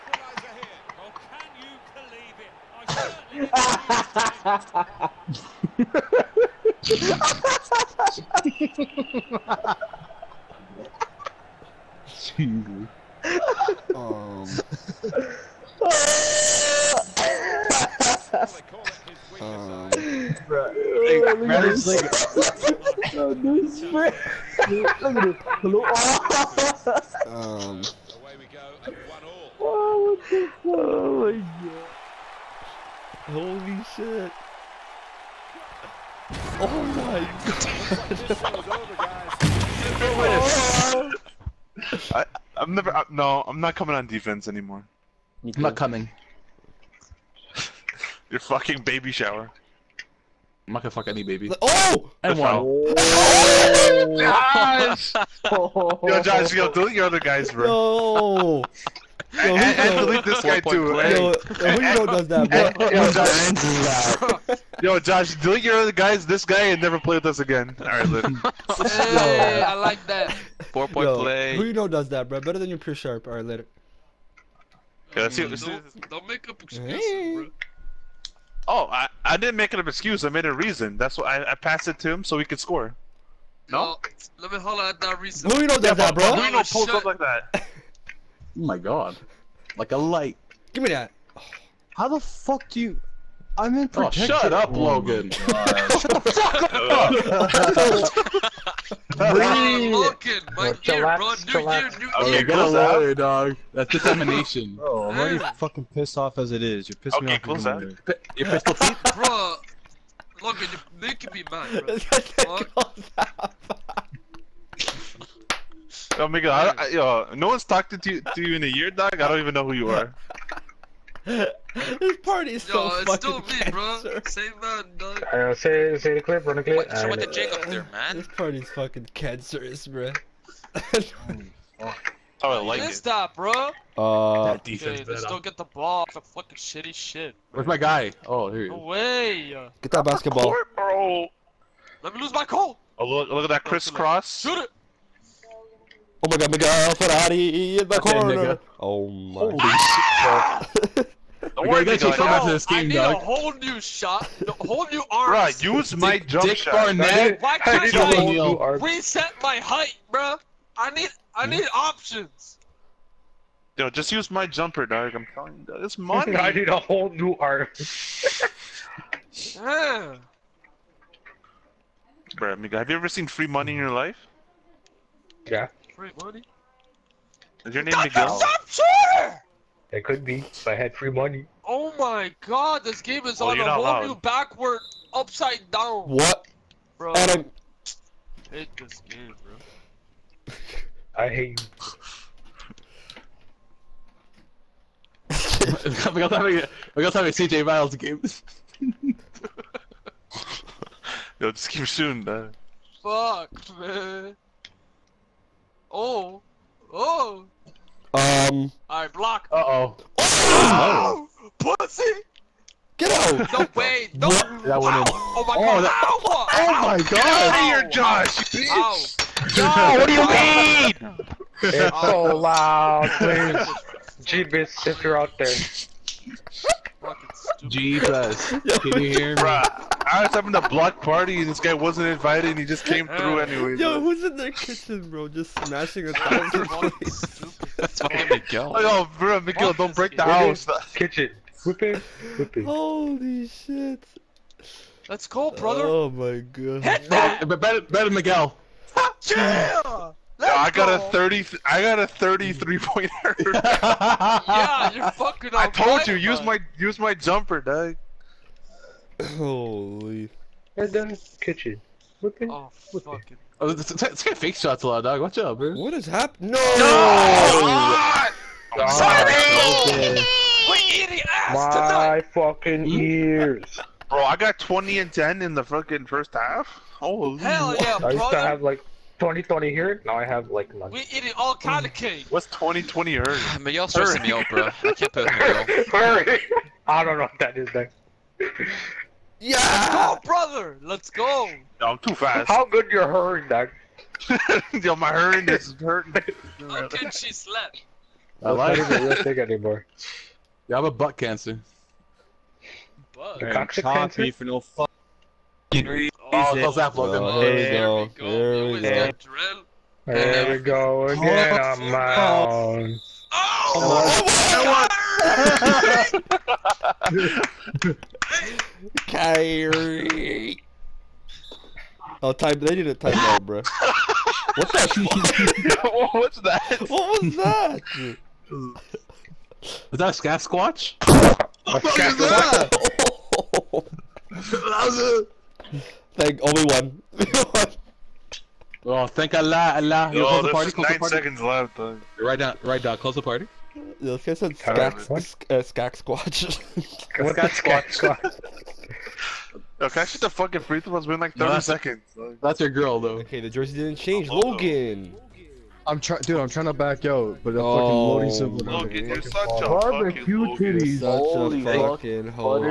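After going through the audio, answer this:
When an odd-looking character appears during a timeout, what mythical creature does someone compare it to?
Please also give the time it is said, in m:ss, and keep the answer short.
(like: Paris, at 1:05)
Sasquatch, at 5:30.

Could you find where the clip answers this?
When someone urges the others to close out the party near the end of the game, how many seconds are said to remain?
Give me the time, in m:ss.
5:40.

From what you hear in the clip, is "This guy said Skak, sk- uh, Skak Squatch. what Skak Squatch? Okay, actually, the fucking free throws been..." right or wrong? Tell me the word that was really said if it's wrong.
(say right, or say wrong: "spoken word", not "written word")
right.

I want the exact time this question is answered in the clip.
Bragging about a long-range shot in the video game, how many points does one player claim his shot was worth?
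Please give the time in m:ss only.
4:12.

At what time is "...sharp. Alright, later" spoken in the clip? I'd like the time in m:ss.
1:12.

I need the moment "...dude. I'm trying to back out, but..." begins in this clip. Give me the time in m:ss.
5:56.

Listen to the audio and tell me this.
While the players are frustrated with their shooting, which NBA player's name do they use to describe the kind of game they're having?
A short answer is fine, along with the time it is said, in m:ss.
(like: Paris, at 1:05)
CJ Miles, at 3:17.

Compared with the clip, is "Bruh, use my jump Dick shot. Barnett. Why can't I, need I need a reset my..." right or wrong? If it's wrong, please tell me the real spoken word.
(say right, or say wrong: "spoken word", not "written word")
right.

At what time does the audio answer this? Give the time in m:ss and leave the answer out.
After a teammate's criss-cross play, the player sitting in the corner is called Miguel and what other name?
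2:26.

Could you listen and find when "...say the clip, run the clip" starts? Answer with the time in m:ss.
2:05.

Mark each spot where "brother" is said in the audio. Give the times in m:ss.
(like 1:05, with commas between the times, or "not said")
4:05, 4:50.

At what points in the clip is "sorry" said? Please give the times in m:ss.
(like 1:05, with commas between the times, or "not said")
4:28.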